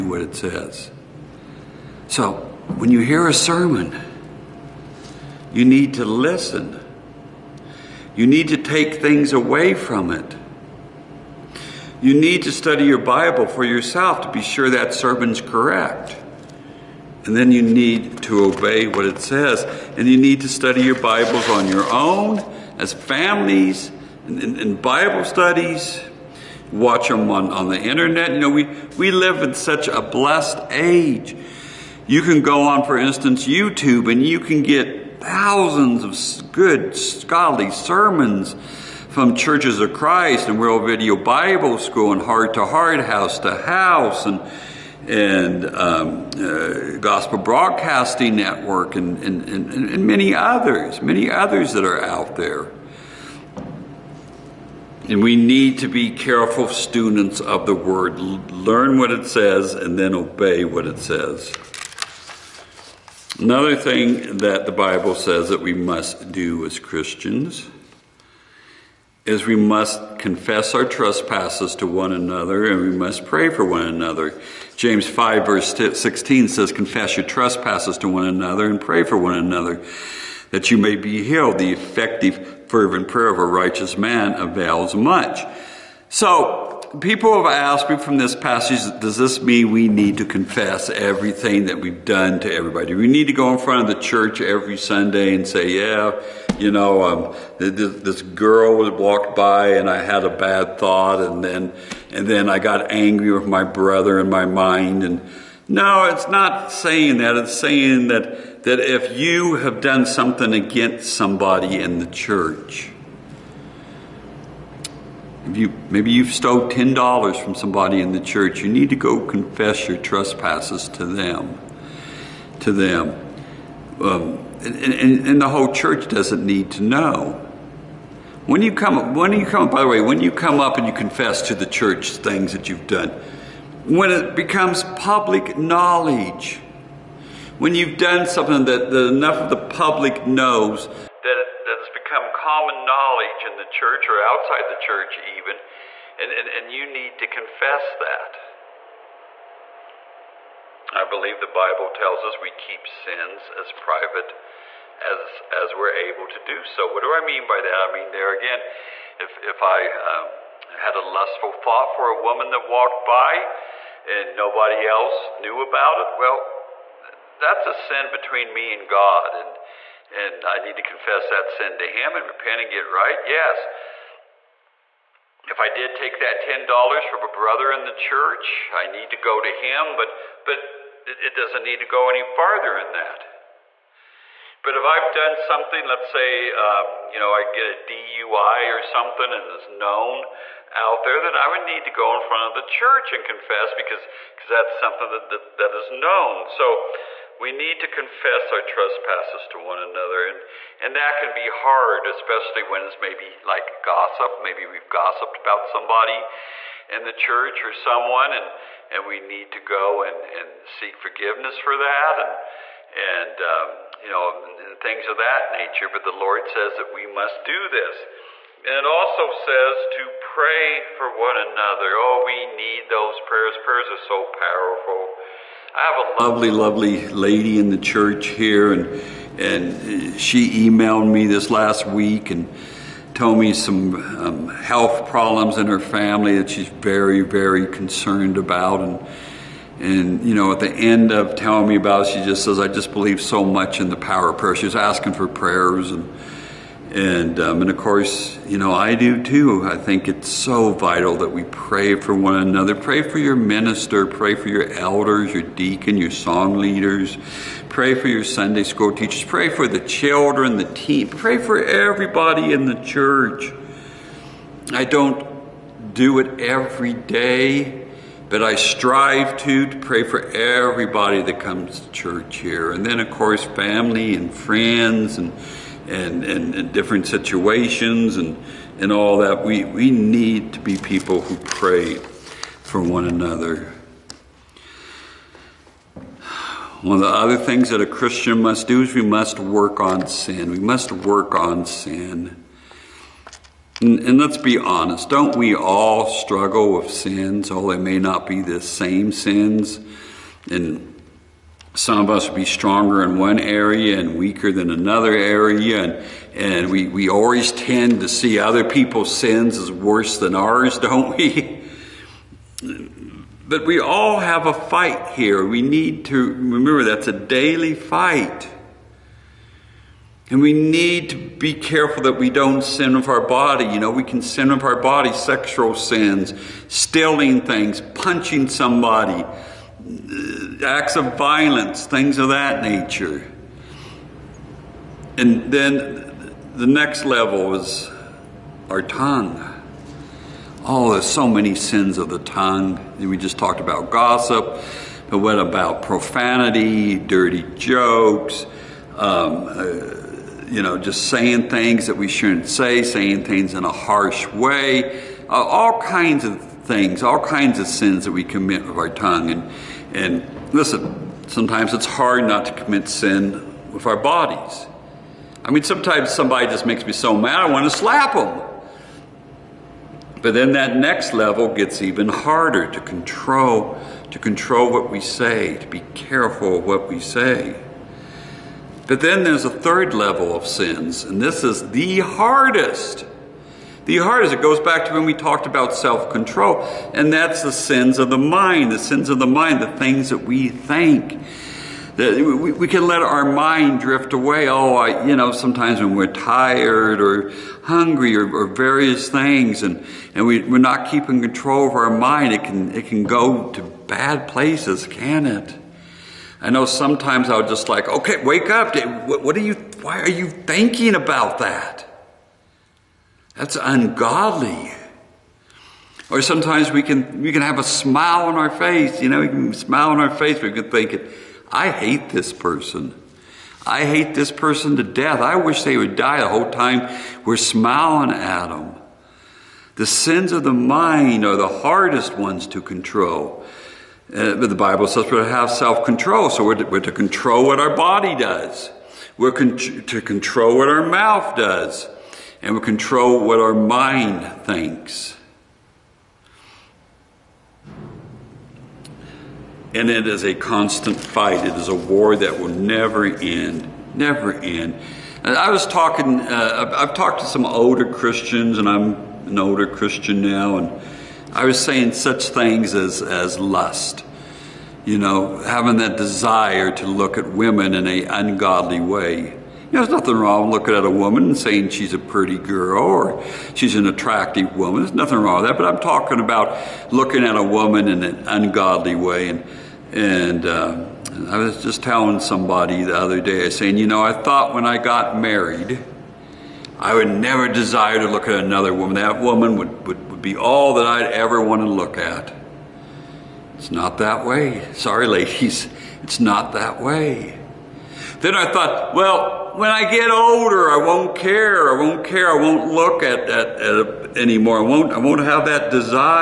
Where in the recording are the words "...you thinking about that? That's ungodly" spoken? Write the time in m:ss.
6:50.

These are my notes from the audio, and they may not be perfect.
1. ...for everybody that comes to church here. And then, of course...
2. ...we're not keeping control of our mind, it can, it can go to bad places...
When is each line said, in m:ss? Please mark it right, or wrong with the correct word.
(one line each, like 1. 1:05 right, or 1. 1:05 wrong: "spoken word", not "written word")
1. 4:30 right
2. 6:40 right.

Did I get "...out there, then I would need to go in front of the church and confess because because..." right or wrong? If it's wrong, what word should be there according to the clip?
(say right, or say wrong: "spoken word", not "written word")
right.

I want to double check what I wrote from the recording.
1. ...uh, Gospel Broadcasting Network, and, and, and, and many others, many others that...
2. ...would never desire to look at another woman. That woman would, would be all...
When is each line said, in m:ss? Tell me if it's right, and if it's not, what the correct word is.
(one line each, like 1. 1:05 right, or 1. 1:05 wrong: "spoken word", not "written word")
1. 0:46 right
2. 8:06 right.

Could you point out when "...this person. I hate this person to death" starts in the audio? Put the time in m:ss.
7:02.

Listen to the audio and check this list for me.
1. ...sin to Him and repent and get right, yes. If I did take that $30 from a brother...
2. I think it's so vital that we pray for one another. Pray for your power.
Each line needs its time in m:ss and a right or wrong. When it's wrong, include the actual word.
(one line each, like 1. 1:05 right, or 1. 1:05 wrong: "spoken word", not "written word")
1. 2:51 wrong: "10", not "30"
2. 4:09 wrong: "minister", not "power".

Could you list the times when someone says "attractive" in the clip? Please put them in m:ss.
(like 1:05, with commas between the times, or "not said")
7:53.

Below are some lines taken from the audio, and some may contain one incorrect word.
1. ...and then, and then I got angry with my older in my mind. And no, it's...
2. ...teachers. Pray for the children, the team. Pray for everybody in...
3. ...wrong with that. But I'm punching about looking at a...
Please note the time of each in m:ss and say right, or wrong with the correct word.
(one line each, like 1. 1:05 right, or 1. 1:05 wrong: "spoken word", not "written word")
1. 1:41 wrong: "brother", not "older"
2. 4:18 right
3. 7:55 wrong: "talking", not "punching".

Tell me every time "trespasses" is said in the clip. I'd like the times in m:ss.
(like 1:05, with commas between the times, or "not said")
1:10, 1:17, 1:59, 3:18.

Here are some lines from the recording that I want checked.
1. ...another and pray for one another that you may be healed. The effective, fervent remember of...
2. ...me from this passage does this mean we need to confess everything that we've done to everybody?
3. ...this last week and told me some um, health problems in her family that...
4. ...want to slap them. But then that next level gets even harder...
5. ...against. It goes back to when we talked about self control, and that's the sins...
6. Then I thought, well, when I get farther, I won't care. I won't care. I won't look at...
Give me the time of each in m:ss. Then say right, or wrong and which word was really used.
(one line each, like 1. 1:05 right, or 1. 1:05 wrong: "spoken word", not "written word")
1. 1:18 wrong: "prayer", not "remember"
2. 1:27 right
3. 3:51 right
4. 6:07 right
5. 6:23 wrong: "hardest", not "against"
6. 8:18 wrong: "older", not "farther".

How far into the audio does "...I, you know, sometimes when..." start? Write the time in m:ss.
6:34.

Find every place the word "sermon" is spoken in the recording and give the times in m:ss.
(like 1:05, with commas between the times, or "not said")
0:03, 0:14, 0:37.